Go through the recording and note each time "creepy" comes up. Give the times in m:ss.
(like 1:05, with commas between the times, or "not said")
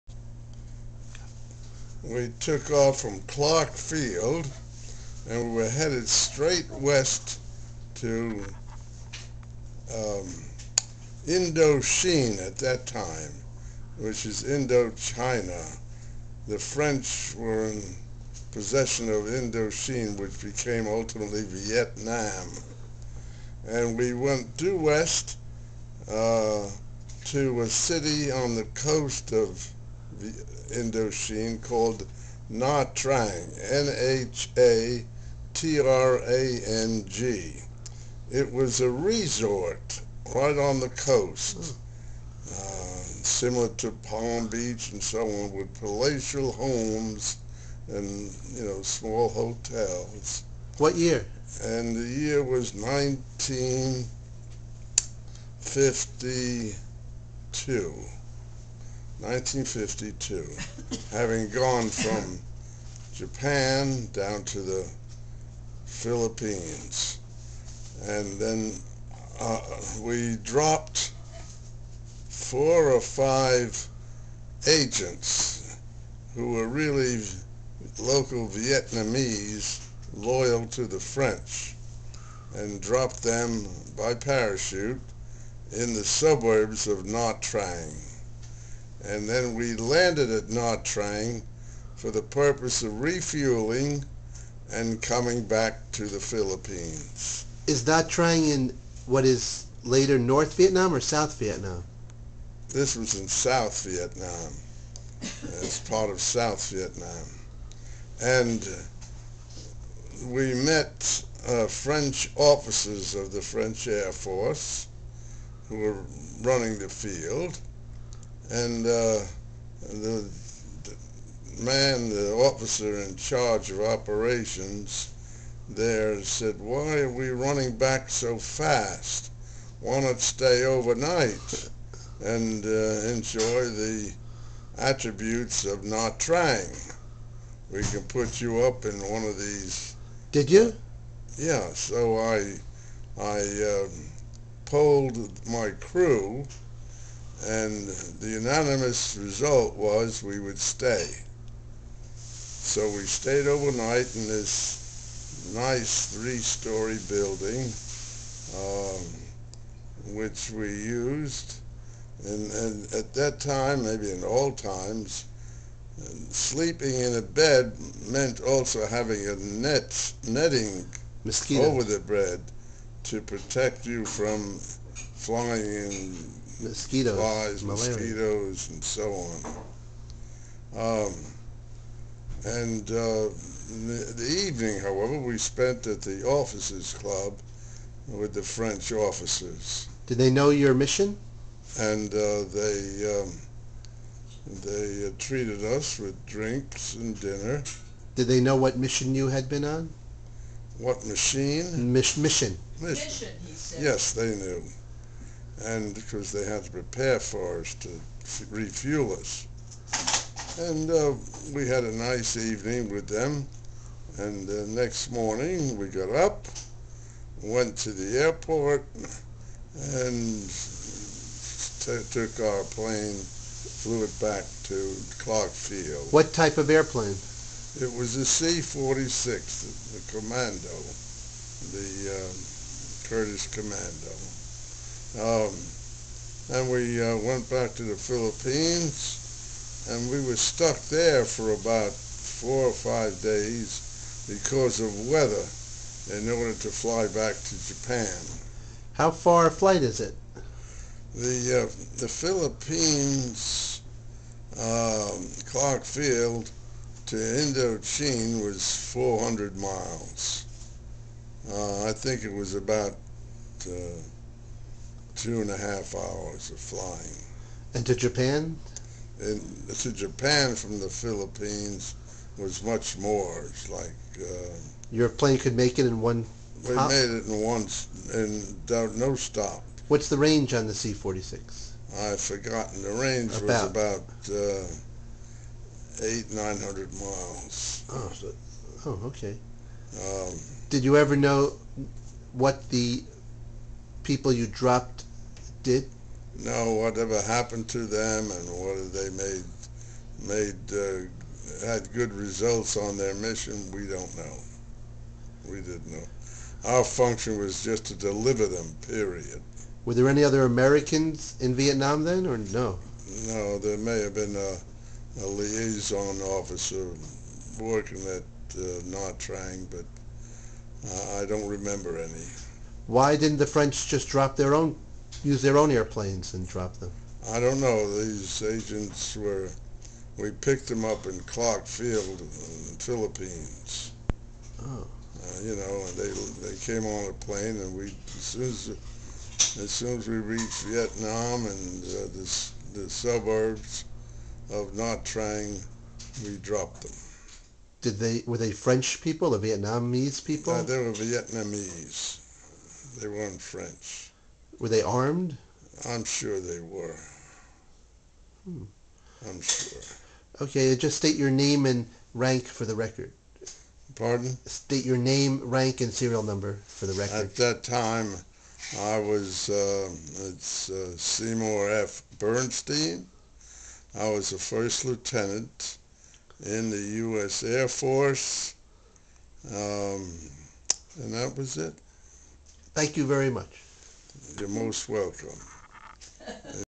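not said.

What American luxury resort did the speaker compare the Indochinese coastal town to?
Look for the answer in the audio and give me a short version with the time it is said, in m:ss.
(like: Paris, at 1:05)
Palm Beach, at 0:43.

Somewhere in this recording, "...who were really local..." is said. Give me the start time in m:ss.
1:16.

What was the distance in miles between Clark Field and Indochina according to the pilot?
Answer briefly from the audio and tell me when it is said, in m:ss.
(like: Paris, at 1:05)
400 miles, at 4:18.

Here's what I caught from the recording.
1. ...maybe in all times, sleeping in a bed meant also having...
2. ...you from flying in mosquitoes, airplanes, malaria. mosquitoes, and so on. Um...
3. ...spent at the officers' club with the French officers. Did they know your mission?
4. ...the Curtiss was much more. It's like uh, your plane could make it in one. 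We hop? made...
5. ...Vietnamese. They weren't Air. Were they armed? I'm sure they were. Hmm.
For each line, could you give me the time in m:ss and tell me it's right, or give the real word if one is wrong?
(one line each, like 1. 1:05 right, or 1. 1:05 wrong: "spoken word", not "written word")
1. 2:43 right
2. 2:53 wrong: "flies", not "airplanes"
3. 3:05 right
4. 4:30 wrong: "Philippines", not "Curtiss"
5. 5:50 wrong: "French", not "Air".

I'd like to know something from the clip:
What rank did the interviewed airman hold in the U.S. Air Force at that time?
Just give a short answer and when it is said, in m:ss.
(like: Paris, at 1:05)
First lieutenant, at 6:14.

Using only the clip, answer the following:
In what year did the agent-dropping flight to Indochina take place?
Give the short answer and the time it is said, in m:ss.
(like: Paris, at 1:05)
1952, at 0:51.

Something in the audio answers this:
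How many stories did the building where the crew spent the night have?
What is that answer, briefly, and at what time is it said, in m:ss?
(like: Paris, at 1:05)
3, at 2:36.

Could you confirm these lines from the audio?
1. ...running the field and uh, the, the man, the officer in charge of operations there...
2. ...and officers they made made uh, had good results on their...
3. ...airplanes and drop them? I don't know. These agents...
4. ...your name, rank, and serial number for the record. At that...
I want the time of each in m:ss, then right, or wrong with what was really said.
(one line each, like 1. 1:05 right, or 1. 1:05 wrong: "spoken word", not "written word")
1. 1:56 right
2. 4:58 wrong: "whether", not "officers"
3. 5:25 right
4. 6:04 right.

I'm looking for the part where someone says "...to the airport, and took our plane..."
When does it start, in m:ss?
3:37.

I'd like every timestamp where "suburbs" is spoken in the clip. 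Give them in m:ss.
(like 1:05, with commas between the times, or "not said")
1:26, 5:42.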